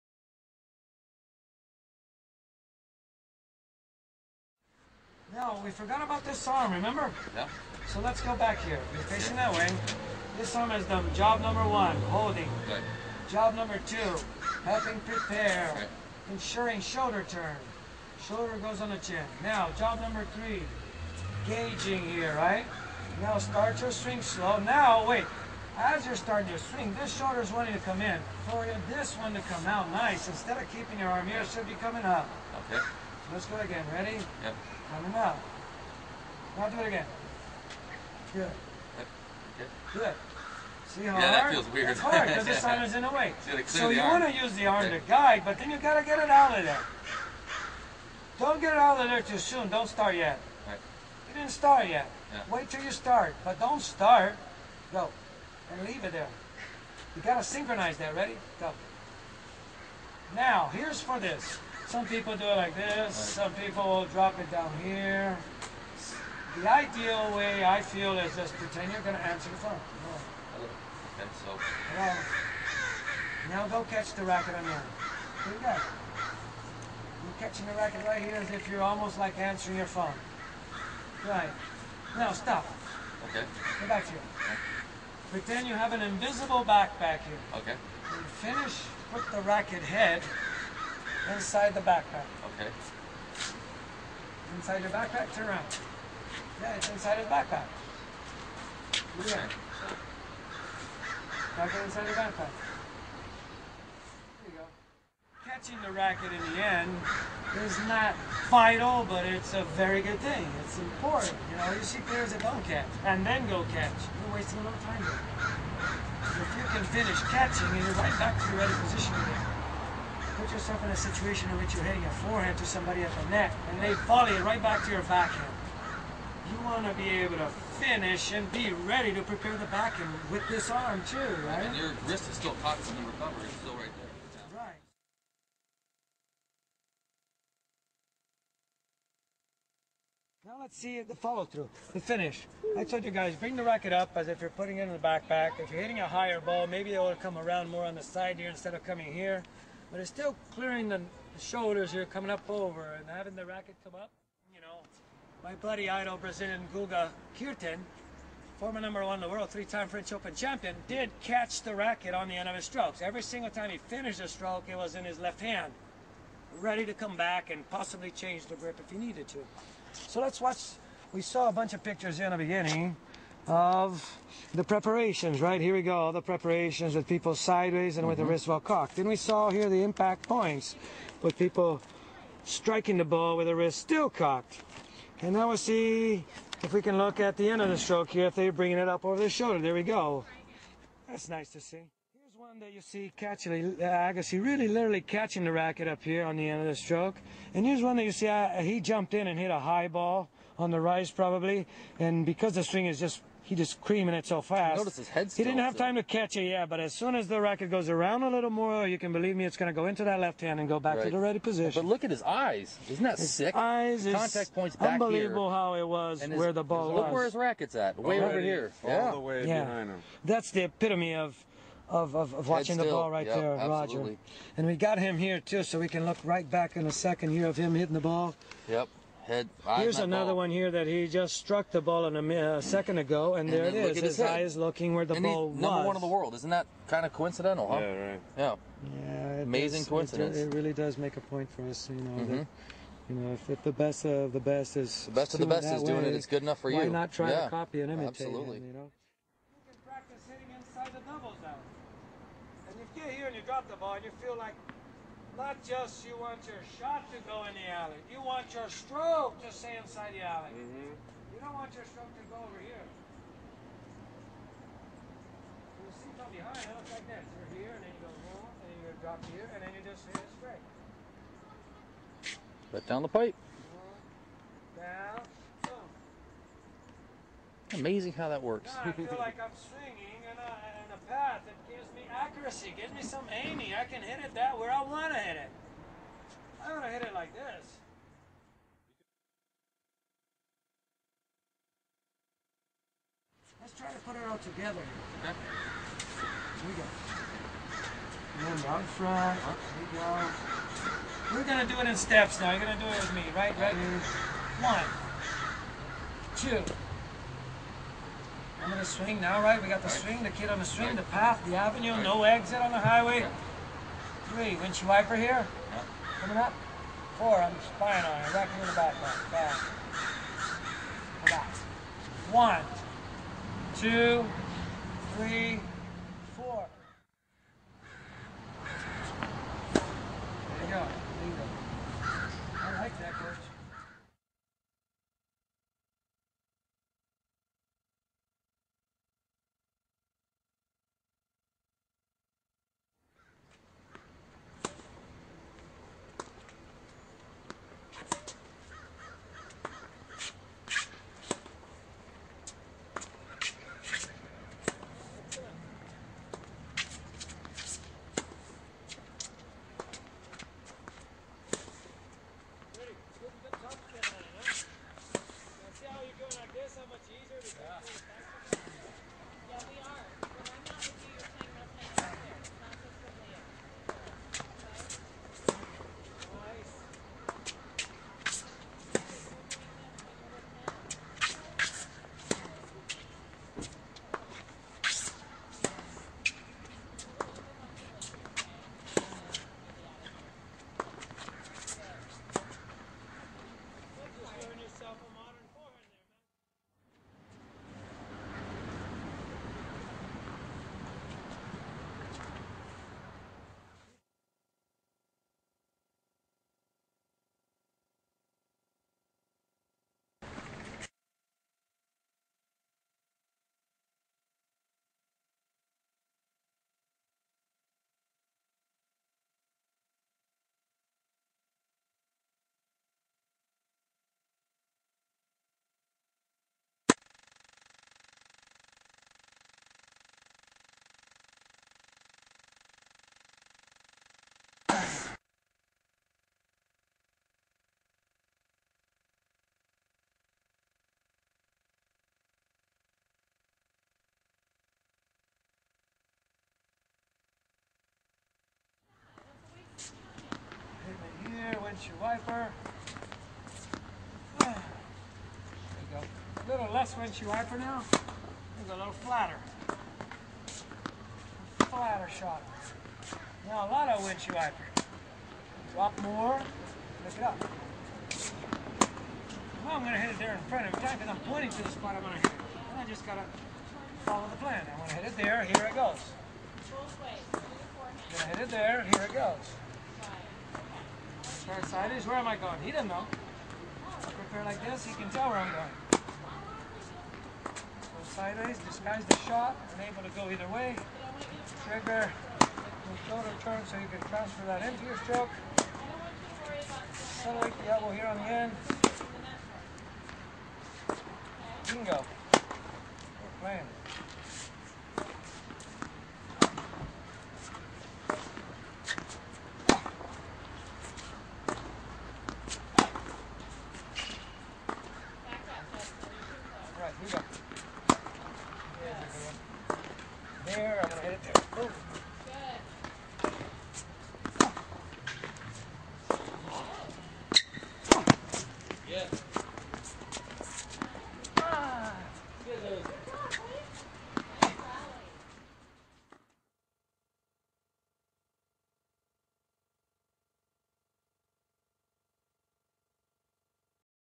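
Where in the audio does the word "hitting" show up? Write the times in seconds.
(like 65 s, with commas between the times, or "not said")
121 s, 145 s, 227 s, 250 s.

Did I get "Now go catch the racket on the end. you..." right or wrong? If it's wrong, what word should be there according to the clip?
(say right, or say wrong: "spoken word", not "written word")
right.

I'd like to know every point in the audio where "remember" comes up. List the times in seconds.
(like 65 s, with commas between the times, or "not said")
6 s, 298 s.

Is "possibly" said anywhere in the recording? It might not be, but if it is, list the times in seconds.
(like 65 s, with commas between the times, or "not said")
167 s.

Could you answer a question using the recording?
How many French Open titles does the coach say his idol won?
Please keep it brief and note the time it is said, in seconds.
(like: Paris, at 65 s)
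3, at 159 s.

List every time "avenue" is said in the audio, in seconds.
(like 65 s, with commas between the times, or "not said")
311 s.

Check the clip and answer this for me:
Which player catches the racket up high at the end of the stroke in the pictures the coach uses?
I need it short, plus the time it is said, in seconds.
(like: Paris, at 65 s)
Agassi, at 193 s.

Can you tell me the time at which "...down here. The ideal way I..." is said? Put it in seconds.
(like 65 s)
64 s.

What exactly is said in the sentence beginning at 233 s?
His, his eye is looking where the and ball was.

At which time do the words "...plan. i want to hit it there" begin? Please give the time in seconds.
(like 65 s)
474 s.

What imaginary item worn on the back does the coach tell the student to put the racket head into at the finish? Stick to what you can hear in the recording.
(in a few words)
Invisible backpack.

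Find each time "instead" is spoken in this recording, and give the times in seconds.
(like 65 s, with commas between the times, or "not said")
30 s, 148 s.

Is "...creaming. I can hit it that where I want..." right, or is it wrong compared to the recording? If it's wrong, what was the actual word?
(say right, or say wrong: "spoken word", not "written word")
wrong: "aiming", not "creaming".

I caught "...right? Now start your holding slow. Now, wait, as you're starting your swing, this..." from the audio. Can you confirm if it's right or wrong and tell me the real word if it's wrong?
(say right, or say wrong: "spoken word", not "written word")
wrong: "swing", not "holding".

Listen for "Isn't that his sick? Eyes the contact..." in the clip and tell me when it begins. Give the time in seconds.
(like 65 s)
212 s.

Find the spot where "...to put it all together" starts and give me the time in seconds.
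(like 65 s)
293 s.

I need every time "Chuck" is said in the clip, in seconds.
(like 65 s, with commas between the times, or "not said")
not said.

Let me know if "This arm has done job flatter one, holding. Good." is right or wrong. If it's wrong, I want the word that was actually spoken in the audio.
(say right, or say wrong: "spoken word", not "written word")
wrong: "number", not "flatter".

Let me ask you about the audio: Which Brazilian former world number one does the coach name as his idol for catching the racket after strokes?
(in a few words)
Guga Kuerten.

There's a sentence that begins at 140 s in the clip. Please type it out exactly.
Now let's see the follow through, the finish.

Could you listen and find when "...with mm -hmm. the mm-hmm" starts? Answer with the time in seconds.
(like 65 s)
178 s.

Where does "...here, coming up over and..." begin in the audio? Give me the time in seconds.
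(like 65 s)
151 s.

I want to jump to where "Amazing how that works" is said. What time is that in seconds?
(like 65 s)
277 s.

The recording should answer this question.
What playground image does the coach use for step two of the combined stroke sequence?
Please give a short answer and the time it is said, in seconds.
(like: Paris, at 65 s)
Kid on the swing, at 310 s.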